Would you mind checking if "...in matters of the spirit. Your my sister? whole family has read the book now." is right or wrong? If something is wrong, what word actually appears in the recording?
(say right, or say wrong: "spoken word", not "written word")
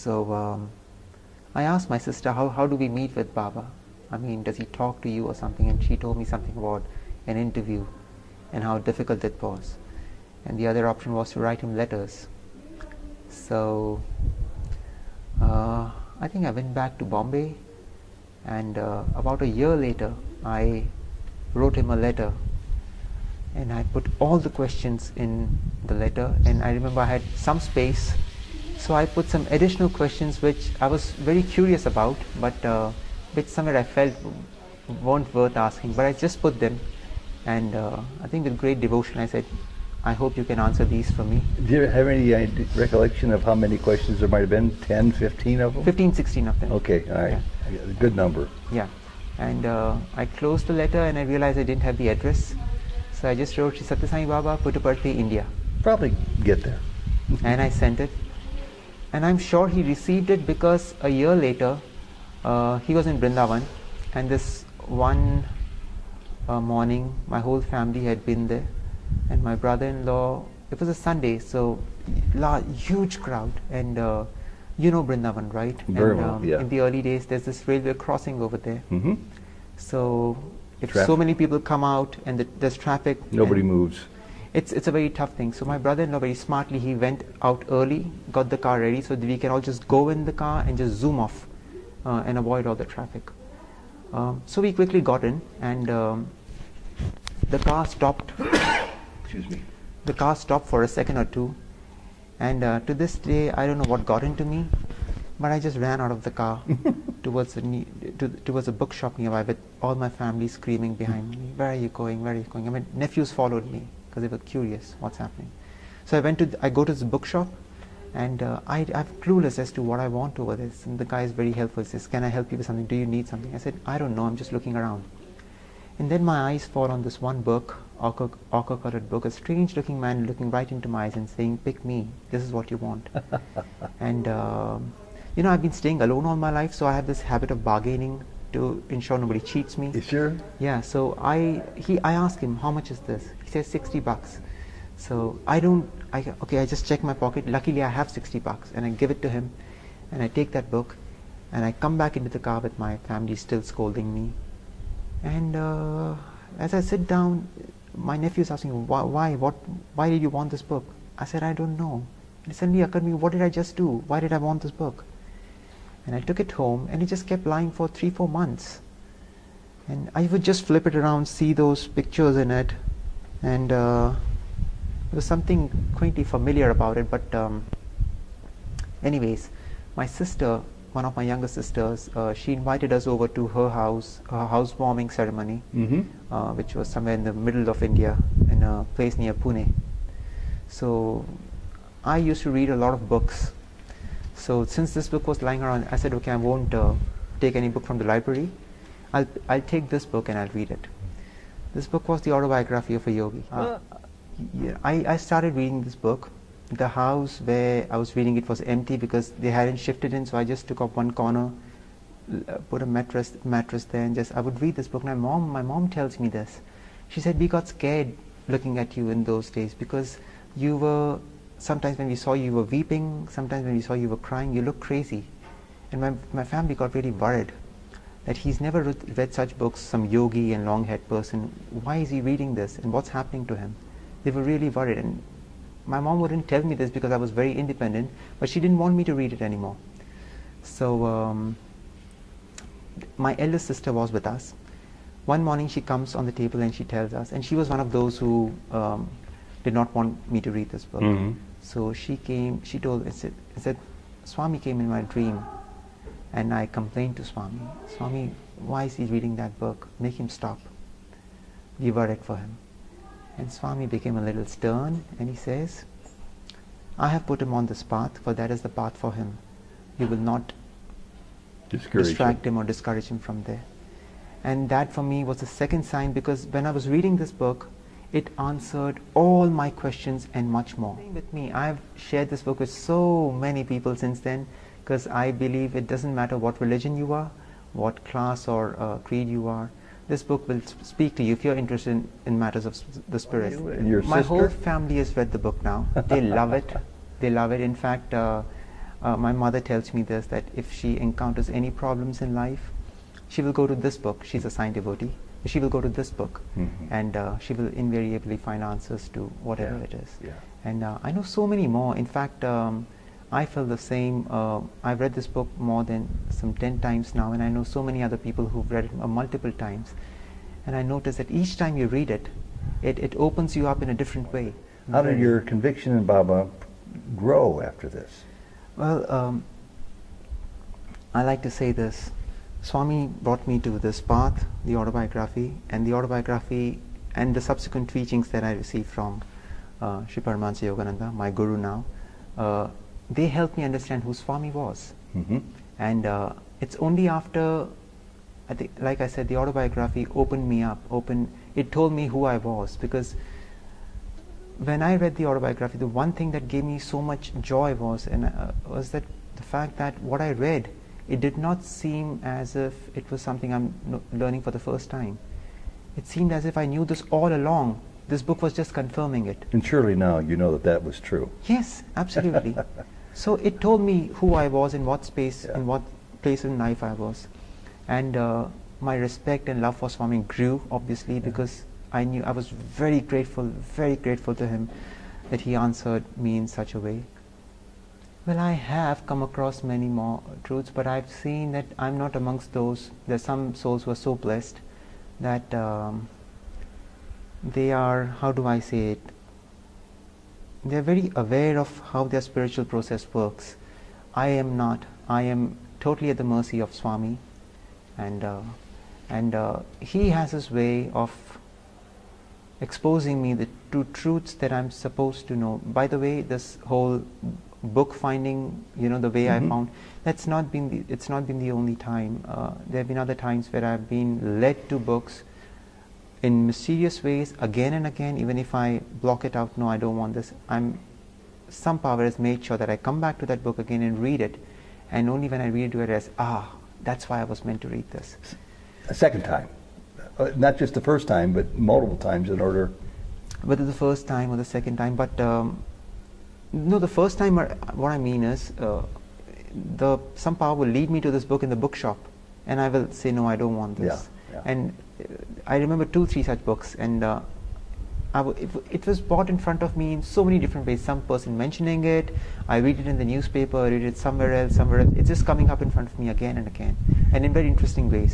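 right.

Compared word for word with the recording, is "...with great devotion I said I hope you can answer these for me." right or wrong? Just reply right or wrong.
right.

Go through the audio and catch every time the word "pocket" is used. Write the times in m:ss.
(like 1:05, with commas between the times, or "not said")
2:27.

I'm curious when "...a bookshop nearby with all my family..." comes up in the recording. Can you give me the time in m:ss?
1:48.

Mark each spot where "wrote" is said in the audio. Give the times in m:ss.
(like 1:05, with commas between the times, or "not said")
0:21, 0:53.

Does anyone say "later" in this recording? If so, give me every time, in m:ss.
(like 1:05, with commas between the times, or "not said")
0:19, 1:01.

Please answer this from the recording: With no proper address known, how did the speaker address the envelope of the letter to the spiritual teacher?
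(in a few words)
Sri Sathya Sai Baba, Puttaparthi, India.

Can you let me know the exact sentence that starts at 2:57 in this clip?
But, um, anyways, my sister, one of my younger sisters, uh, she invited us over to her house, her housewarming ceremony, mm-hmm.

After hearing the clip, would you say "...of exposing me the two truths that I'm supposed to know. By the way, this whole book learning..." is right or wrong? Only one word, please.
wrong.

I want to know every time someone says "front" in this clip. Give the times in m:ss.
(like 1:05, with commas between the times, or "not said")
7:39, 7:45.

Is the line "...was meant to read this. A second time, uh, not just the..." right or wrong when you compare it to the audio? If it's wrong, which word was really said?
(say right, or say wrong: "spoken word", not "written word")
right.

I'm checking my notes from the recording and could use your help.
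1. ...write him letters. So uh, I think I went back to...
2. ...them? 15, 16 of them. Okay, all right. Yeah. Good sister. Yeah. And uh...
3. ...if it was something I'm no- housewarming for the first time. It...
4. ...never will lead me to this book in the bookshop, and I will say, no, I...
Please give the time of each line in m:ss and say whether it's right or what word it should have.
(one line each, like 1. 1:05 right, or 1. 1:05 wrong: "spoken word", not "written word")
1. 0:11 right
2. 0:45 wrong: "number", not "sister"
3. 6:02 wrong: "learning", not "housewarming"
4. 7:30 wrong: "power", not "never".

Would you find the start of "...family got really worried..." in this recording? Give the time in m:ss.
3:46.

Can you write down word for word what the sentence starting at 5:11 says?
In fact, um, I feel the same.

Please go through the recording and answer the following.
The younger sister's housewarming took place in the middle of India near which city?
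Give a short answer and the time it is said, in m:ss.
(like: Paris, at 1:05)
Pune, at 3:09.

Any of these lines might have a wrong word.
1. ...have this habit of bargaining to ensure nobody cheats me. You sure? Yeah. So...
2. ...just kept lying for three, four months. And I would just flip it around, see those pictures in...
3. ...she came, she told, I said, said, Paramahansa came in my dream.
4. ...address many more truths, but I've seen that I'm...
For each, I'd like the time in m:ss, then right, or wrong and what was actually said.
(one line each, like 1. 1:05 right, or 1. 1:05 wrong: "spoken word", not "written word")
1. 2:16 right
2. 2:47 right
3. 4:11 wrong: "Swami", not "Paramahansa"
4. 6:29 wrong: "across", not "address".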